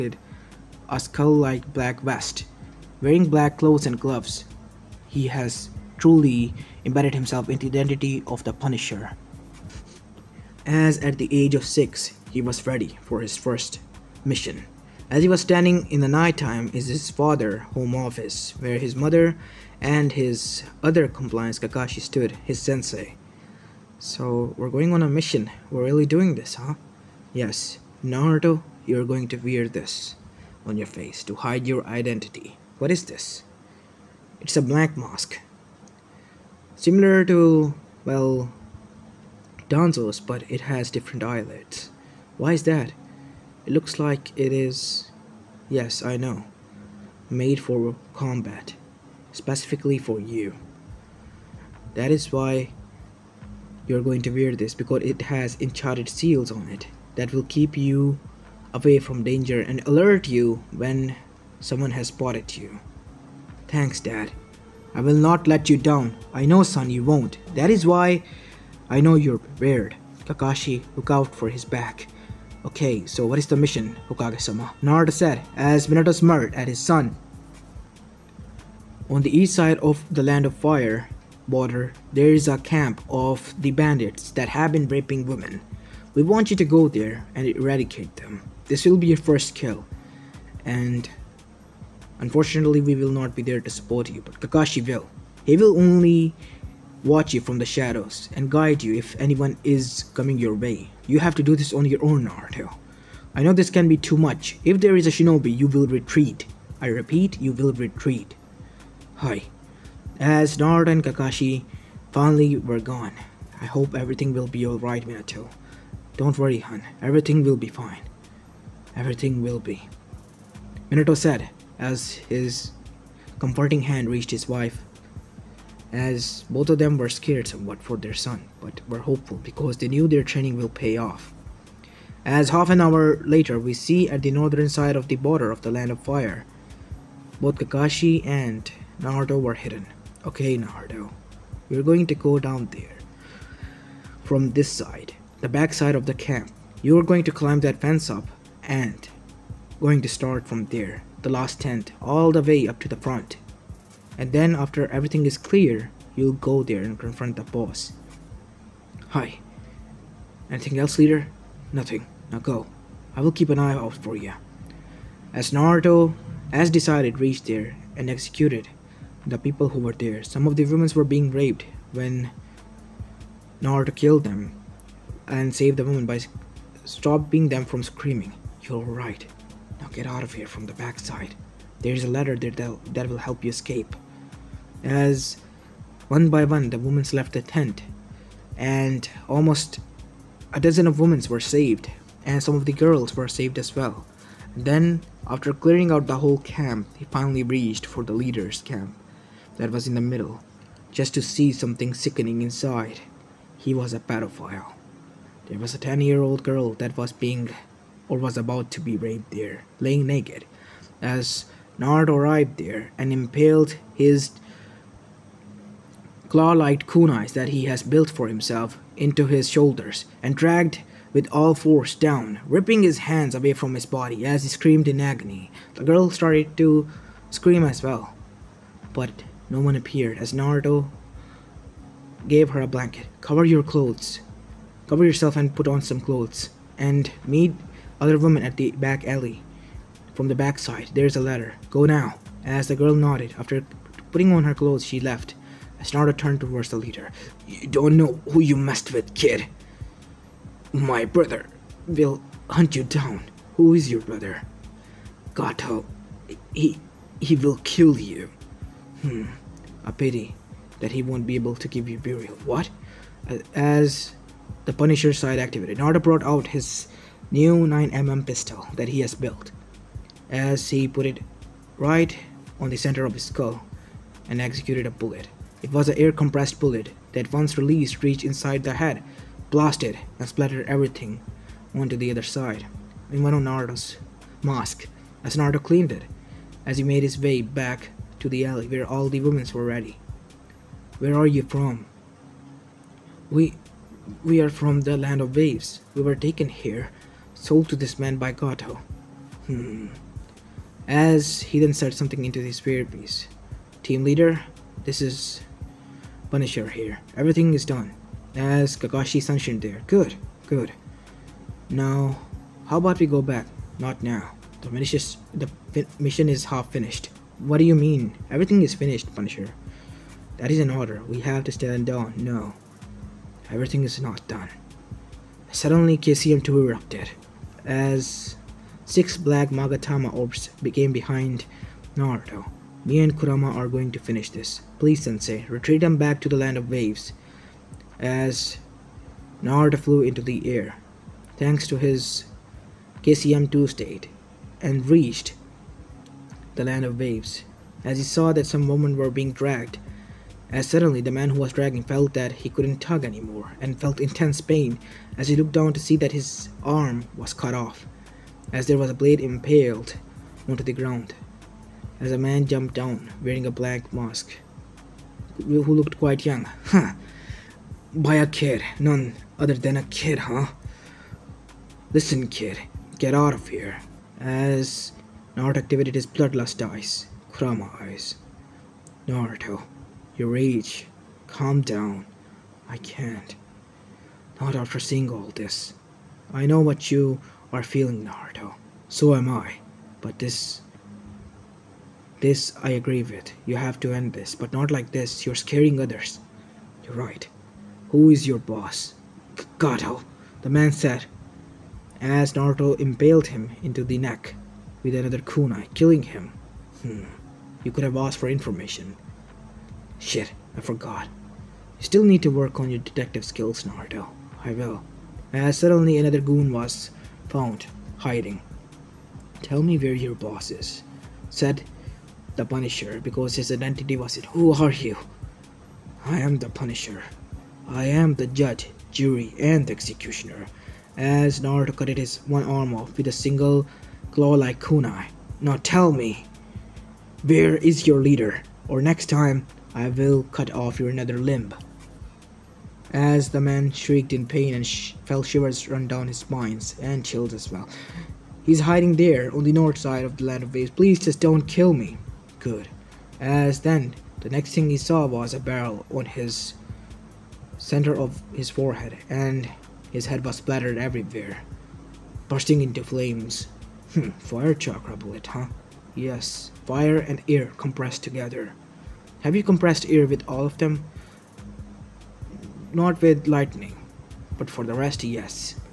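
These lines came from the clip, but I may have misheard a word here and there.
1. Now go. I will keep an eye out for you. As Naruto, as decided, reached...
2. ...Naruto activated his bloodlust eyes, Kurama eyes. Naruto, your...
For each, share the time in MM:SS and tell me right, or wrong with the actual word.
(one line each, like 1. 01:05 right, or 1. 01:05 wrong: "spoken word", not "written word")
1. 02:42 right
2. 06:15 right.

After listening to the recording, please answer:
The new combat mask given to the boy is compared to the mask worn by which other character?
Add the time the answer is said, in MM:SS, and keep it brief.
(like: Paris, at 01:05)
Danzo, at 00:39.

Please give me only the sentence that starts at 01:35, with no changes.
He will only watch you from the shadows and guide you if anyone is coming your way.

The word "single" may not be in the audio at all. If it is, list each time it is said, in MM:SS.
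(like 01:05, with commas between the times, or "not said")
07:13.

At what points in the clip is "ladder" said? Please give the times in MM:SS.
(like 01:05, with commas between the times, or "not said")
03:02, 04:01.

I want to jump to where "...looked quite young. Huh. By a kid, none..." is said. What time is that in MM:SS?
06:05.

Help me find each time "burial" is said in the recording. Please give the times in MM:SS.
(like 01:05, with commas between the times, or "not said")
04:21.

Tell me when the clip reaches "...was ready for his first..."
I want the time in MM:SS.
00:12.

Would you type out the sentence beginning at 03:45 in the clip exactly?
The girl started to scream as well, but no one appeared as Naruto gave her a blanket.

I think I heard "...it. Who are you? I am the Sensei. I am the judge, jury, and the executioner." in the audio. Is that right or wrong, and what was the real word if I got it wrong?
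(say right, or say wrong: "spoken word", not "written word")
wrong: "Punisher", not "Sensei".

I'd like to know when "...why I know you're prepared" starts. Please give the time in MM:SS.
01:07.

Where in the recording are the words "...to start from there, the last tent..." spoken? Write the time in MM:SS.
02:30.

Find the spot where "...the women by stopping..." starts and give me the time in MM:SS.
02:55.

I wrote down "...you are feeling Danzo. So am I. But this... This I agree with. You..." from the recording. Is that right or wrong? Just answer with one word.
wrong.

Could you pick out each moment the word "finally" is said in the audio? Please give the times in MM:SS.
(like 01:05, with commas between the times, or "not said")
01:52, 03:17.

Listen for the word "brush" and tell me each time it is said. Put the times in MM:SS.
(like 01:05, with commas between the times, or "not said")
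not said.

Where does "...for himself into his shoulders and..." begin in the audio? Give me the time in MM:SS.
03:38.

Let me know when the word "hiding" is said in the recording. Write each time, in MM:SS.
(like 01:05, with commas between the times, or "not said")
06:57, 07:28.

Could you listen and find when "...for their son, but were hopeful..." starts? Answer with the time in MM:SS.
02:07.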